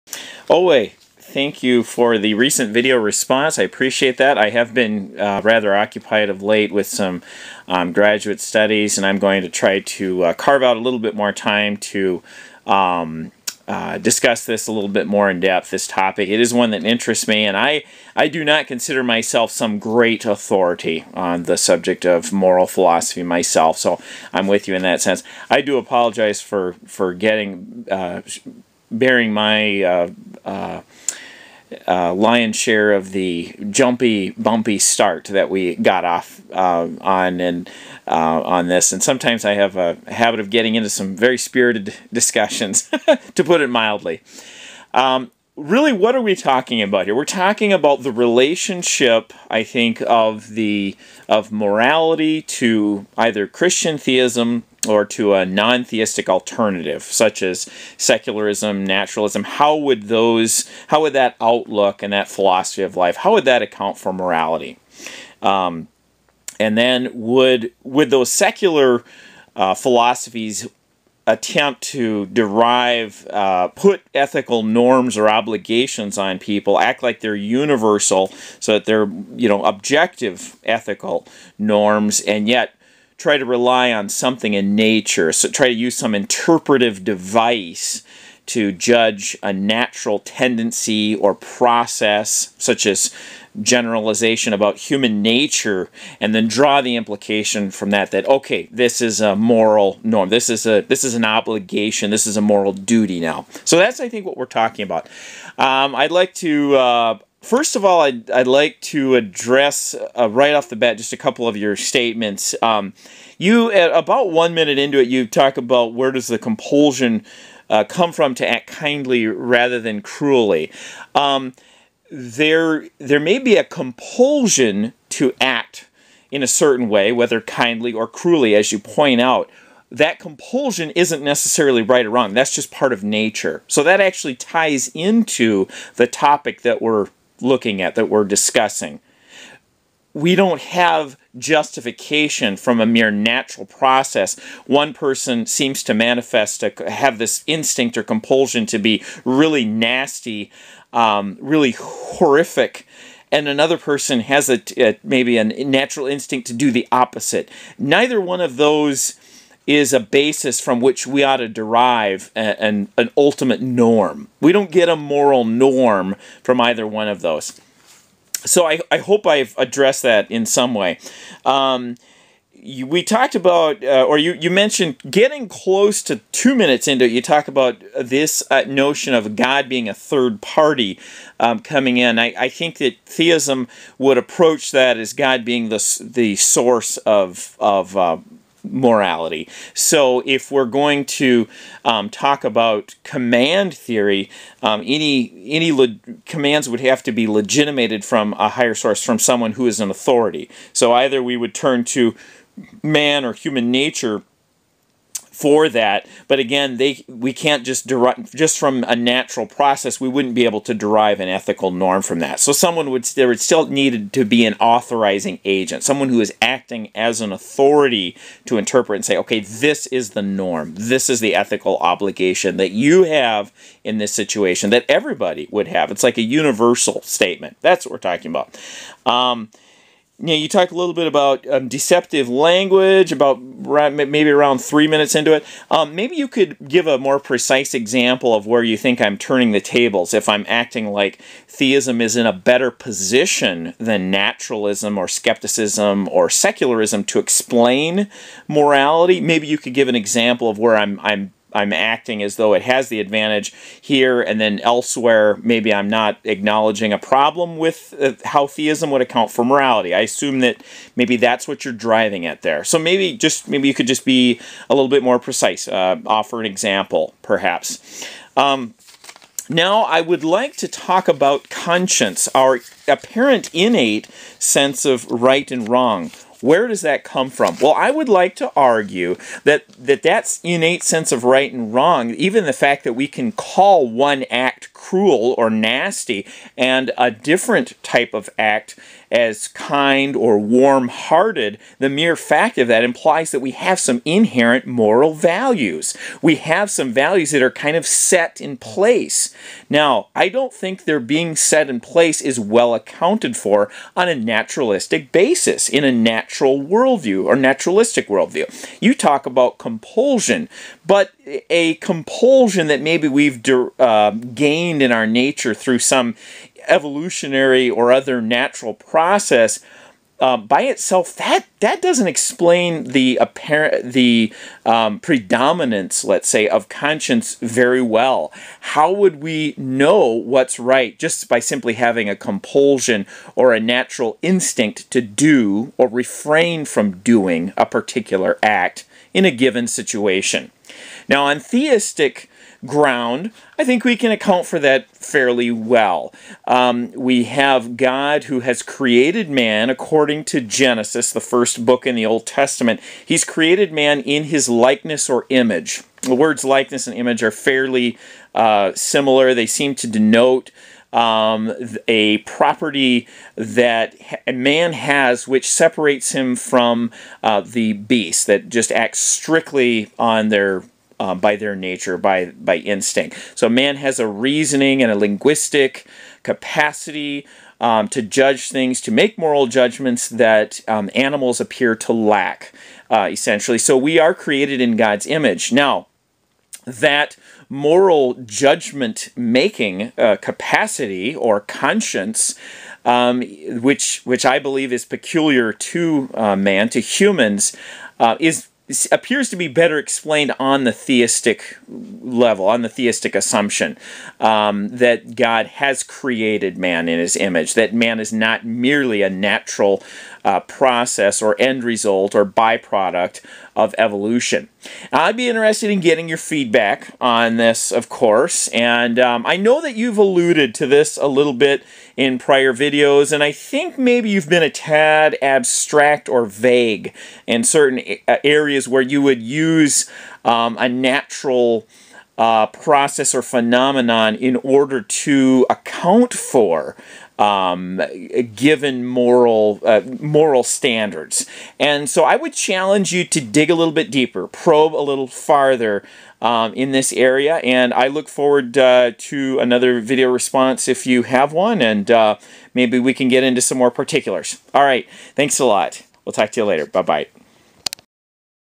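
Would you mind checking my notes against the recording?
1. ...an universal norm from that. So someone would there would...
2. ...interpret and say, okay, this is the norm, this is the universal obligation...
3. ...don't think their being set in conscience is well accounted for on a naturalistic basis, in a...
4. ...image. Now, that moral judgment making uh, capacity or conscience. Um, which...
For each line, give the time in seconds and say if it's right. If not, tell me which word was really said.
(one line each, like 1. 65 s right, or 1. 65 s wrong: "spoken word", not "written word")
1. 211 s wrong: "ethical", not "universal"
2. 218 s wrong: "ethical", not "universal"
3. 300 s wrong: "place", not "conscience"
4. 385 s right.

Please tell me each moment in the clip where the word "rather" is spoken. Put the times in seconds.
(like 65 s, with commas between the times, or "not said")
5 s, 119 s.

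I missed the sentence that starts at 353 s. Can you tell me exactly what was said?
He's created man in his likeness or image.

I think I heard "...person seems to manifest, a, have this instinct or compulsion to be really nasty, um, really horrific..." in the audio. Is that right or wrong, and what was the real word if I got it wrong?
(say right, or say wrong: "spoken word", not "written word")
right.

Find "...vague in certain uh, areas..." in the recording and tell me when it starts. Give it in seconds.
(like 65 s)
426 s.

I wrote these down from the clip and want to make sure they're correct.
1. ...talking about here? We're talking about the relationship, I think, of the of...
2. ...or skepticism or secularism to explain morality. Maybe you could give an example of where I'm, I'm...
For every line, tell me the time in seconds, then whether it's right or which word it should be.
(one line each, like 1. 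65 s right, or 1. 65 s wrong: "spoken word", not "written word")
1. 46 s right
2. 244 s right.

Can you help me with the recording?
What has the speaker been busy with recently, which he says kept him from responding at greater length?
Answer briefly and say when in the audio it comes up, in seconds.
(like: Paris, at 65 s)
graduate studies, at 7 s.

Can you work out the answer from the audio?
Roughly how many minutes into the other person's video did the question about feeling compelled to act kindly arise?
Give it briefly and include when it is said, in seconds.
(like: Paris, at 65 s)
1, at 114 s.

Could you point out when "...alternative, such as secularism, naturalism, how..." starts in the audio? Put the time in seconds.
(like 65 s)
56 s.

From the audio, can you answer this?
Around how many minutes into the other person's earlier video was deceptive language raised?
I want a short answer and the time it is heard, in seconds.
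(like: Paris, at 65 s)
3, at 234 s.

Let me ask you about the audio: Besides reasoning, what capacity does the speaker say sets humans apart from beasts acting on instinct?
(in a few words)
linguistic.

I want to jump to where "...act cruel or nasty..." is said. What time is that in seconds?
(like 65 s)
284 s.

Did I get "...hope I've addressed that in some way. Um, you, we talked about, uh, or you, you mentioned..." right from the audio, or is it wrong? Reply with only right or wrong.
right.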